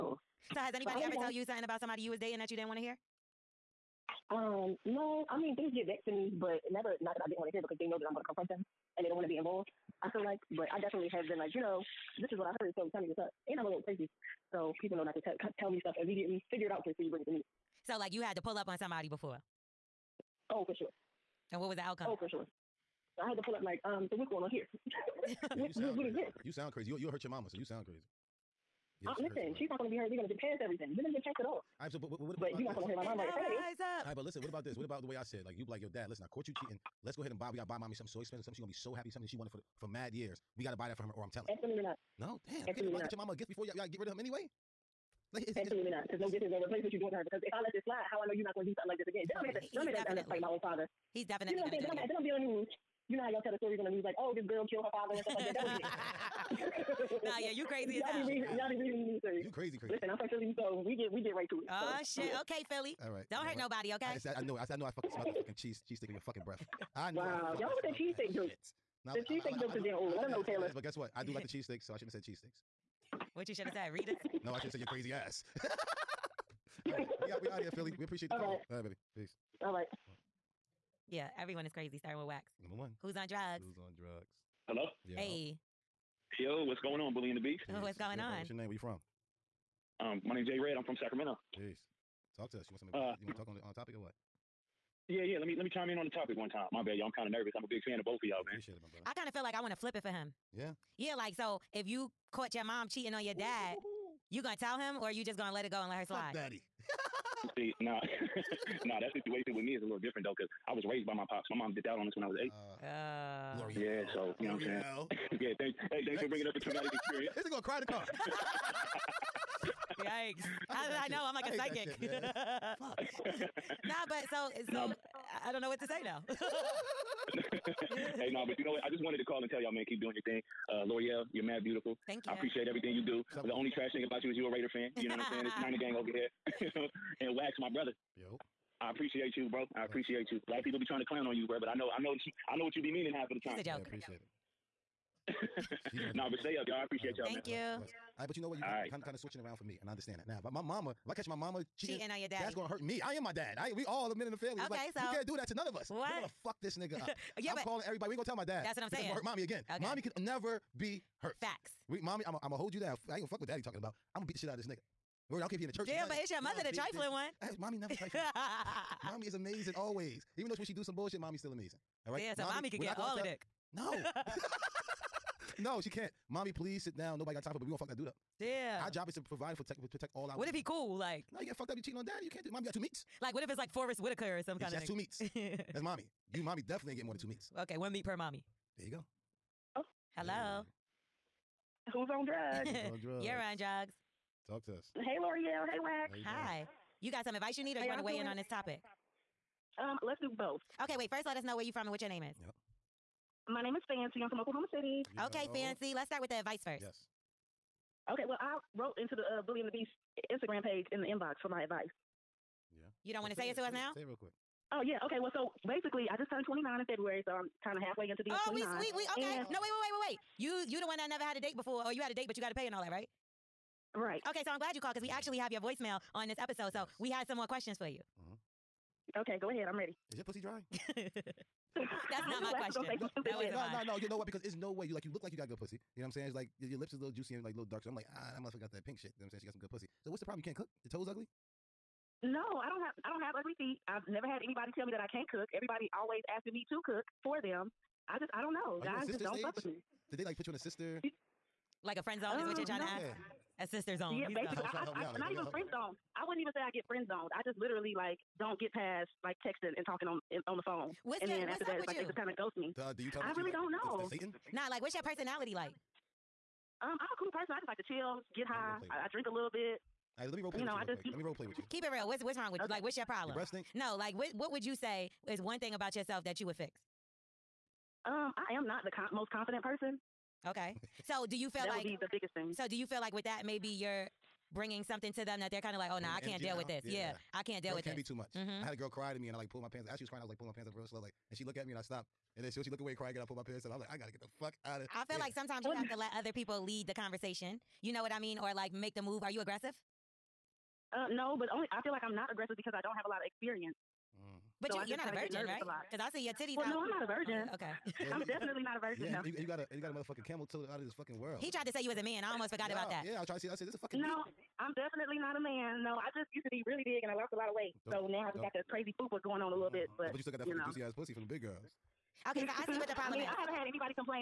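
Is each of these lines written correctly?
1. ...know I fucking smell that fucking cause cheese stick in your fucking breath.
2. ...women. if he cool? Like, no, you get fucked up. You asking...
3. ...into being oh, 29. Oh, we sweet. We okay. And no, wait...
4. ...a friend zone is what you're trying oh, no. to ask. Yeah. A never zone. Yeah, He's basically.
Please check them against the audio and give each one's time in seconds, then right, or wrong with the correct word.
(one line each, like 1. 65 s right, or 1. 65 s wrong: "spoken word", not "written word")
1. 64 s wrong: "cheese", not "cause"
2. 180 s wrong: "cheating", not "asking"
3. 218 s right
4. 251 s wrong: "sister", not "never".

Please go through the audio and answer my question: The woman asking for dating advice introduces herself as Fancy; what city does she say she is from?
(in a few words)
Oklahoma City.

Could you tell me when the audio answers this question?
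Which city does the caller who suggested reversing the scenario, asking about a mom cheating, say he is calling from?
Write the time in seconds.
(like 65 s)
90 s.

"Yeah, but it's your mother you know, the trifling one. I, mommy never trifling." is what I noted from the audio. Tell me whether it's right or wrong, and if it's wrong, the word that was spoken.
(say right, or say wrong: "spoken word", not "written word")
right.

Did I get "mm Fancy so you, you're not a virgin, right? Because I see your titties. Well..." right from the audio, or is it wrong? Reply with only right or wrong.
wrong.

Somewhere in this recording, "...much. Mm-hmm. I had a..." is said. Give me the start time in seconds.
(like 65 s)
288 s.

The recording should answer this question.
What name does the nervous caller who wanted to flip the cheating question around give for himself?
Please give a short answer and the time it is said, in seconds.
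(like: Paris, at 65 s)
Jay Red, at 90 s.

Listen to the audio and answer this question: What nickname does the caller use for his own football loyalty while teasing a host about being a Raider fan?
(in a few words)
Niner gang.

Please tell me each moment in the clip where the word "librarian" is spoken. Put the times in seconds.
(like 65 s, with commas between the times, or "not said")
not said.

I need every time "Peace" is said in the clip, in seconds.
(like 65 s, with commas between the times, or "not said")
79 s.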